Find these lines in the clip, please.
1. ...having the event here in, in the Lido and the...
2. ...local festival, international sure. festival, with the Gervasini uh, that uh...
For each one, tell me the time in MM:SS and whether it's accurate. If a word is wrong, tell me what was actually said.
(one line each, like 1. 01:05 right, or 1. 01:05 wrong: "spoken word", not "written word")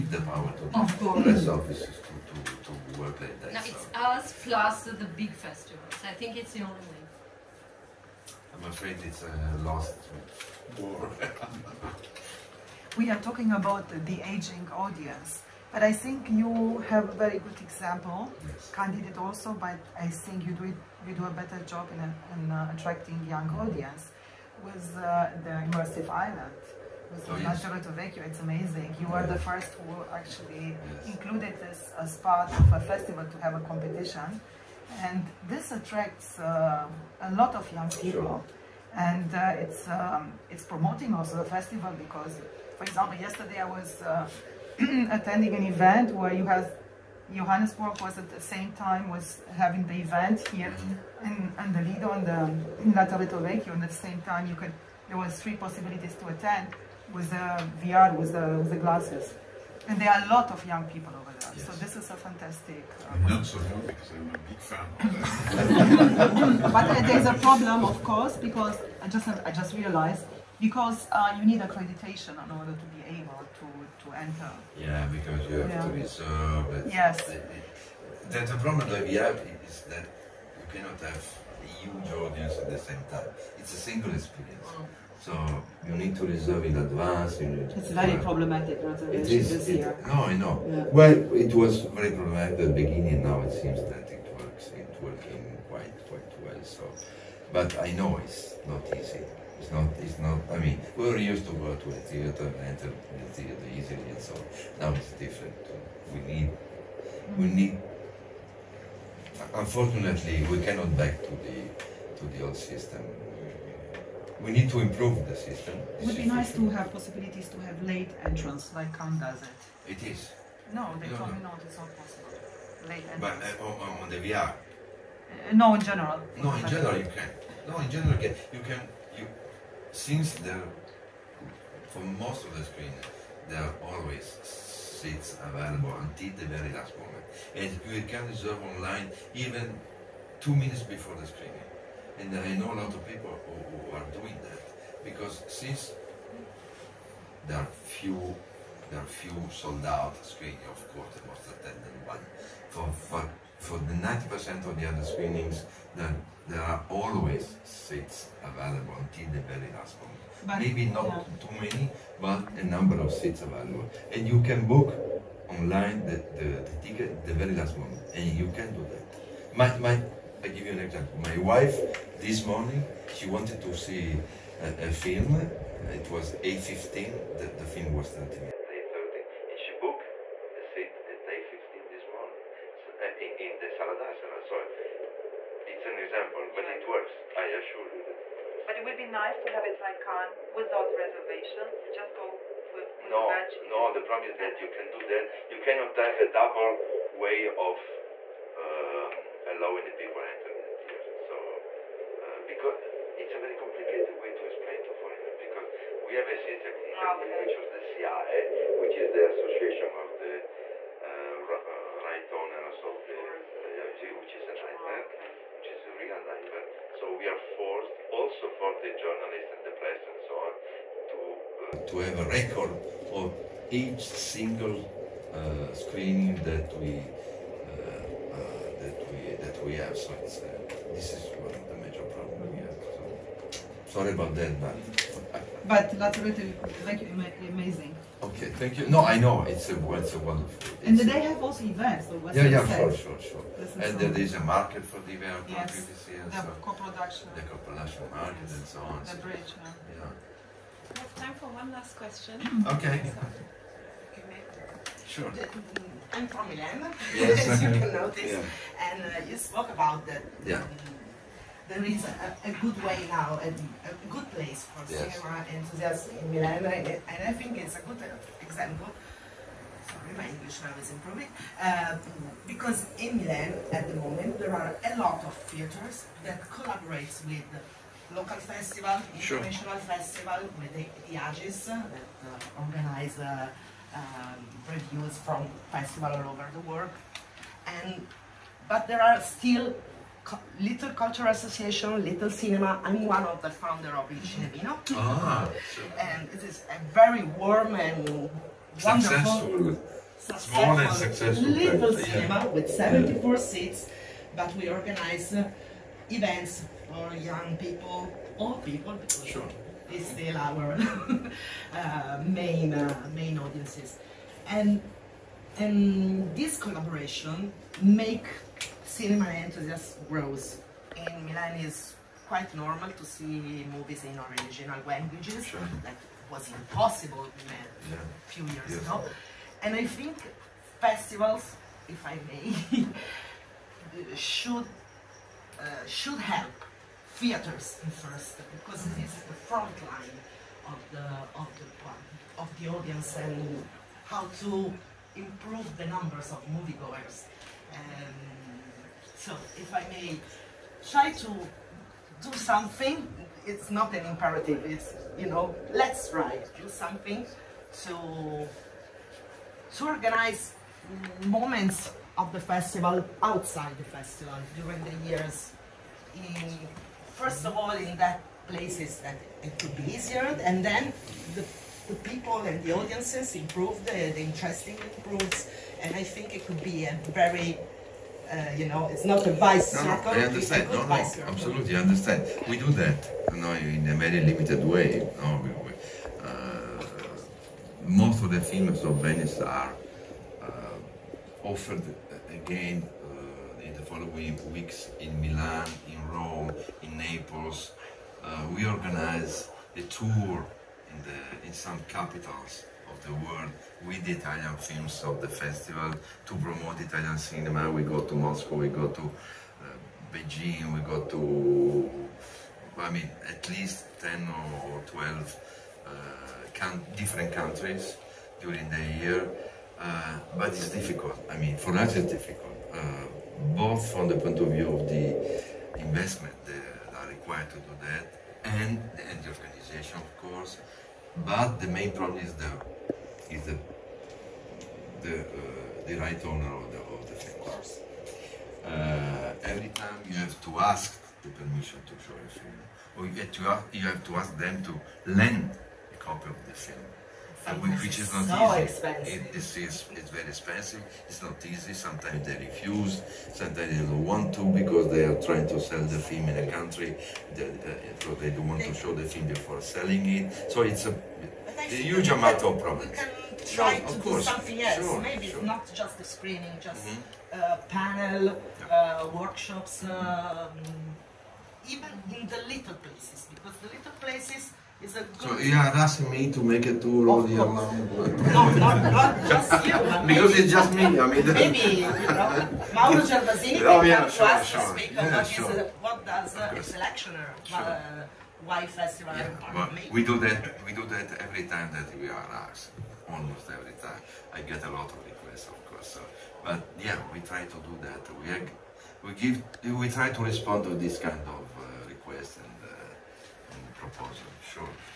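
1. 00:49 right
2. 04:38 wrong: "AGIS", not "Gervasini".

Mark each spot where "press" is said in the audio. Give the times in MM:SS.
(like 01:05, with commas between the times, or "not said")
00:01, 03:39.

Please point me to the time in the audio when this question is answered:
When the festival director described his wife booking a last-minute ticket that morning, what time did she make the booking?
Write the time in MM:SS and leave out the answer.
03:01.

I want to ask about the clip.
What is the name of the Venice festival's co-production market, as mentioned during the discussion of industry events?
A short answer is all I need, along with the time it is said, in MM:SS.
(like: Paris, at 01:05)
The bridge, at 04:09.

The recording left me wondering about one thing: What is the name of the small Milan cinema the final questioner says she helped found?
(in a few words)
Il Cinevino.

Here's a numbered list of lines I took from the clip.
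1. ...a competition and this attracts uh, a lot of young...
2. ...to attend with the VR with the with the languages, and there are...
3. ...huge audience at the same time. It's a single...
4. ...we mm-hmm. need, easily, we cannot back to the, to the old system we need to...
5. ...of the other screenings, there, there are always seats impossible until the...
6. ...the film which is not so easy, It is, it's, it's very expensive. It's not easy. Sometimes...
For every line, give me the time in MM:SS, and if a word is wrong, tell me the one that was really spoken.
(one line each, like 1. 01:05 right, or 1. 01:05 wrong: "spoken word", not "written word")
1. 00:33 right
2. 00:56 wrong: "glasses", not "languages"
3. 01:21 right
4. 01:47 wrong: "unfortunately", not "easily"
5. 02:34 wrong: "available", not "impossible"
6. 07:26 right.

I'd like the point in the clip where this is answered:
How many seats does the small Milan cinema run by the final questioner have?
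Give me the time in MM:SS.
05:02.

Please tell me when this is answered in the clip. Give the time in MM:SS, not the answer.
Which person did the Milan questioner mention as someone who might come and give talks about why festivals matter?
08:02.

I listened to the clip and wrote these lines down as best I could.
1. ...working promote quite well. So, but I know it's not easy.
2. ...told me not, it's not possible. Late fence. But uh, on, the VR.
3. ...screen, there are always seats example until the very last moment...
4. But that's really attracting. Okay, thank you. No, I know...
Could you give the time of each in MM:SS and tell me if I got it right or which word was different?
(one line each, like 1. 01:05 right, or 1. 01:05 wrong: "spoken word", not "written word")
1. 01:35 wrong: "quite", not "promote"
2. 02:01 wrong: "entrance", not "fence"
3. 02:12 wrong: "available", not "example"
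4. 03:55 wrong: "amazing", not "attracting".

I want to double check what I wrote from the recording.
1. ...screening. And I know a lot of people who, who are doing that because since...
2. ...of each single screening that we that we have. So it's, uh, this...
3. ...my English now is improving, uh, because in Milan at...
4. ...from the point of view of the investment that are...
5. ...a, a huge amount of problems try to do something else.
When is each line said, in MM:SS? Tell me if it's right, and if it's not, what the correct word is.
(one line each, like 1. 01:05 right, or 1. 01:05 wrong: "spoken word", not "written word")
1. 02:21 right
2. 03:43 right
3. 04:30 right
4. 07:03 right
5. 07:40 right.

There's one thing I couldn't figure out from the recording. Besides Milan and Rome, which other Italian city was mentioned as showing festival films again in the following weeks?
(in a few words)
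Naples.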